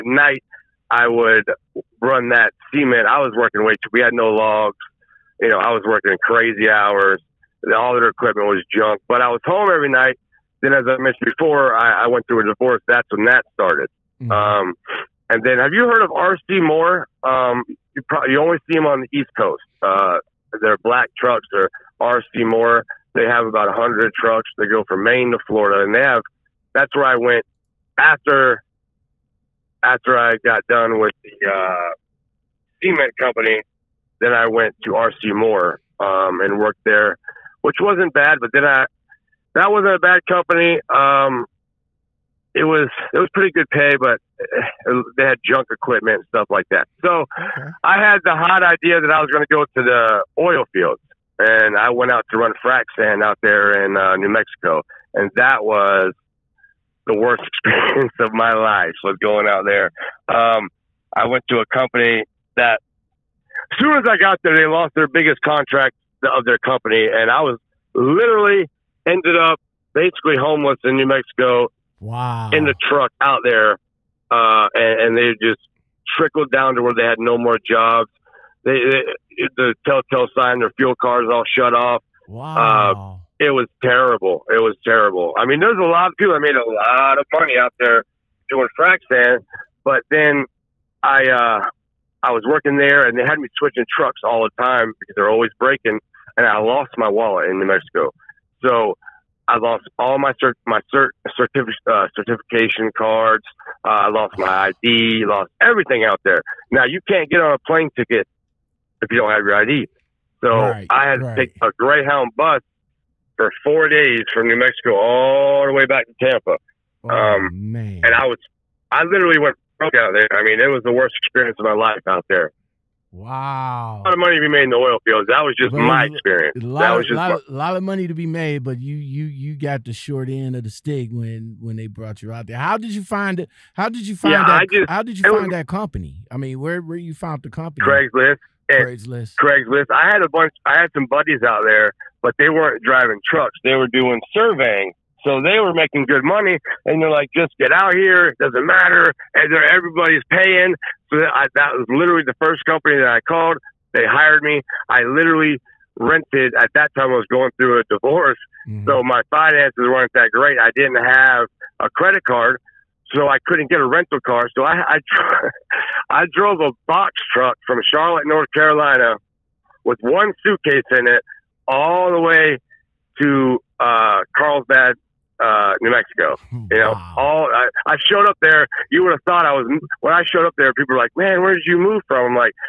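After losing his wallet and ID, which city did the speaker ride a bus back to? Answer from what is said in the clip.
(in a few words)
Tampa.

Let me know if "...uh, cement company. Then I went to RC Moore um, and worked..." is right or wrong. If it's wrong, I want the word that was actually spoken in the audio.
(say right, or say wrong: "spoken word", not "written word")
right.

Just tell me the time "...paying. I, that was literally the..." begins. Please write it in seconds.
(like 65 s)
150 s.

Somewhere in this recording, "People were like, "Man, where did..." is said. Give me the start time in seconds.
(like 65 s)
180 s.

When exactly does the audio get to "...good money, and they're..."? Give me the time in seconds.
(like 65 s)
146 s.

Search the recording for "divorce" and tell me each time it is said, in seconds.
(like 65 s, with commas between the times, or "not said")
12 s, 157 s.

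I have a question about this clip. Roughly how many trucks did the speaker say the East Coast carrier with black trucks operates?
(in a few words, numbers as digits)
100.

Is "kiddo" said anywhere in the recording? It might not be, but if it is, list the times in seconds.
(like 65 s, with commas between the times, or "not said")
not said.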